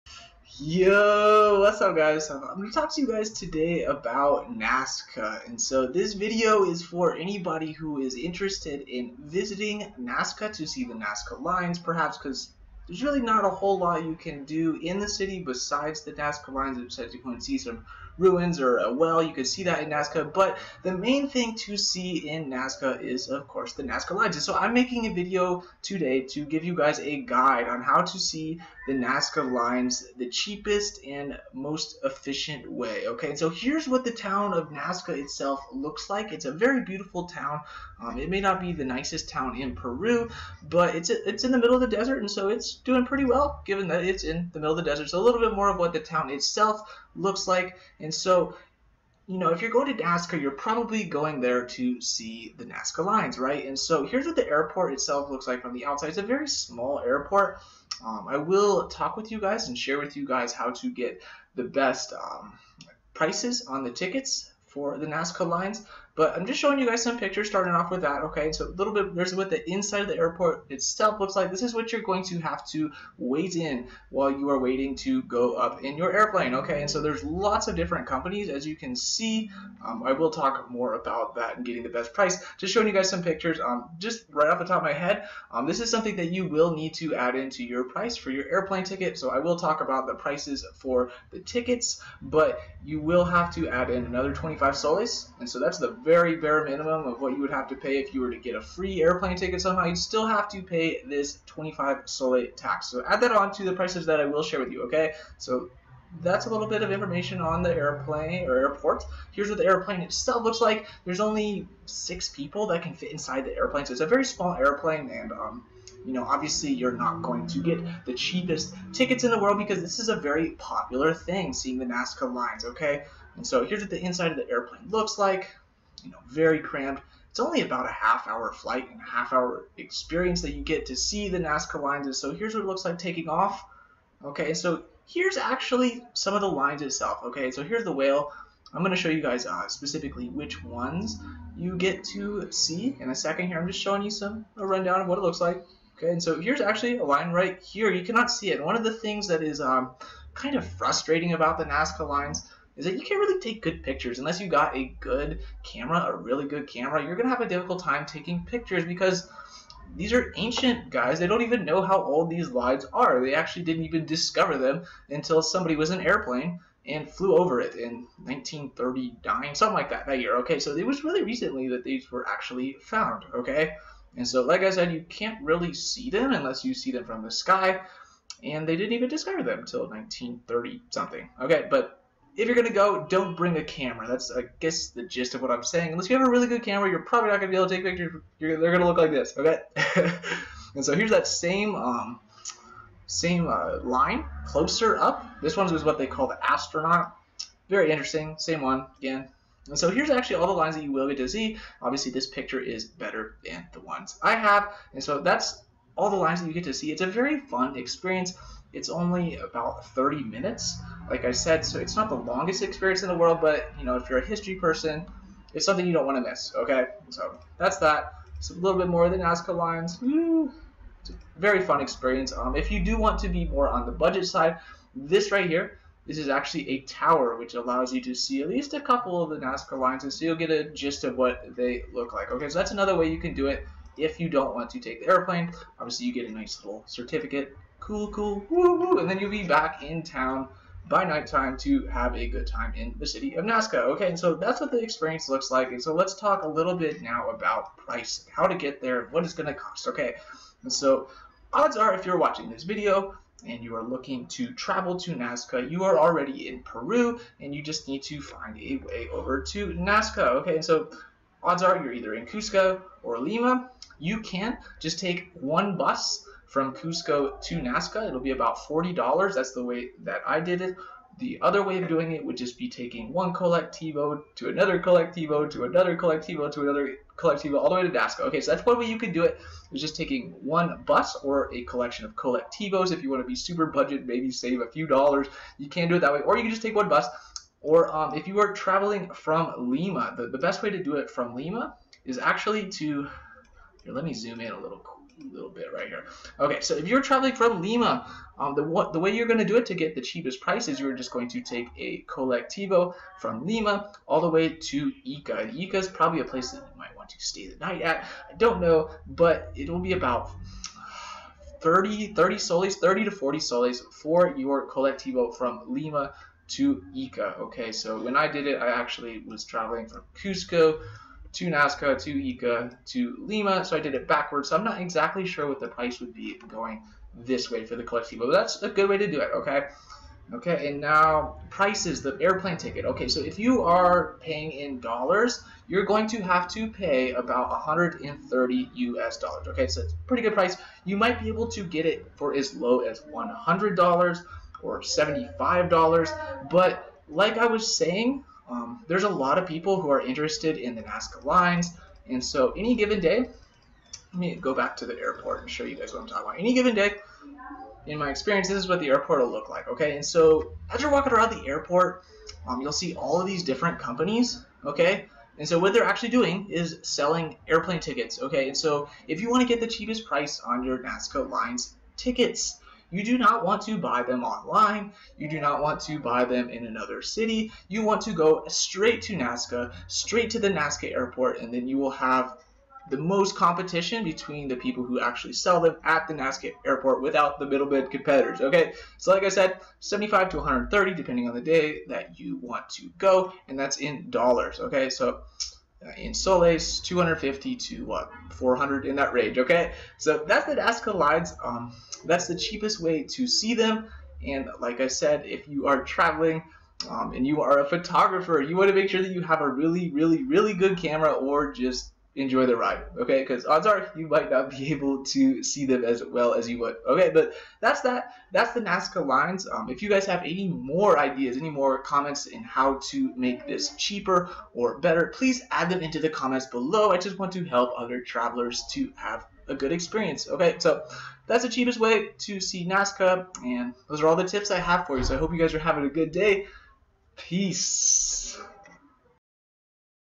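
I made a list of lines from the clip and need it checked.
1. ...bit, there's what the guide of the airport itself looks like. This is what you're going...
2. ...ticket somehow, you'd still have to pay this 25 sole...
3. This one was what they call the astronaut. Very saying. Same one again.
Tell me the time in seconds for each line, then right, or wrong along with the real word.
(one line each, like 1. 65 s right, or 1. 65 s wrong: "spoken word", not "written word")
1. 68 s wrong: "inside", not "guide"
2. 99 s right
3. 195 s wrong: "interesting", not "saying".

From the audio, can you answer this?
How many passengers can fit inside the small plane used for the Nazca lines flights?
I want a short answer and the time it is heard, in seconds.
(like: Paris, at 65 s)
6, at 111 s.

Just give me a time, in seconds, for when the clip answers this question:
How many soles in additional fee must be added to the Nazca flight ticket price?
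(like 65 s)
94 s.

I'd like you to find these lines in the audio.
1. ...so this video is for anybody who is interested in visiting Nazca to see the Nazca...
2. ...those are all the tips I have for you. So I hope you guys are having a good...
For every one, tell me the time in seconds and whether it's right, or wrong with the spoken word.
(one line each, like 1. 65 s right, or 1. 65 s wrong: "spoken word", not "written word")
1. 5 s right
2. 433 s right.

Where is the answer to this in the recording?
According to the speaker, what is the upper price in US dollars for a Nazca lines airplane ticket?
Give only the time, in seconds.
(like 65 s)
337 s.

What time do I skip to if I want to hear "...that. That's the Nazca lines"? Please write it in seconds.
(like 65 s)
417 s.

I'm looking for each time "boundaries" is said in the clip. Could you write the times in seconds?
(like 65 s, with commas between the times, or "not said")
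not said.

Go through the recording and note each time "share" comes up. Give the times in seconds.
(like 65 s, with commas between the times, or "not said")
59 s, 104 s.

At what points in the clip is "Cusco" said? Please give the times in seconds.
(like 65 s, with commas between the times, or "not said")
262 s, 266 s, 320 s.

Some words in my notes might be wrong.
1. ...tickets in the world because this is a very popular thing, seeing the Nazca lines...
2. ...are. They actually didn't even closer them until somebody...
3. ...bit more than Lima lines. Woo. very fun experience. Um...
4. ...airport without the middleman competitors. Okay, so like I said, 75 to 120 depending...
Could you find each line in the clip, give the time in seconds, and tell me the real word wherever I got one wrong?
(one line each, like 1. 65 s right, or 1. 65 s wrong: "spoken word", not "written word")
1. 118 s right
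2. 162 s wrong: "discover", not "closer"
3. 218 s wrong: "Nazca", not "Lima"
4. 386 s wrong: "130", not "120".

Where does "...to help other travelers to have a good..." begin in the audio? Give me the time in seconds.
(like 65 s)
427 s.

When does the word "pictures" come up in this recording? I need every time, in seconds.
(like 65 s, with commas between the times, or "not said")
67 s, 83 s, 153 s, 158 s, 187 s, 202 s.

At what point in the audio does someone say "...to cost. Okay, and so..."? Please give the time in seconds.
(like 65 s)
249 s.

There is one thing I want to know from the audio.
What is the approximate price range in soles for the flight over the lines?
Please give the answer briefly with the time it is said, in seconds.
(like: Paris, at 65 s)
250 to 400 soles, at 396 s.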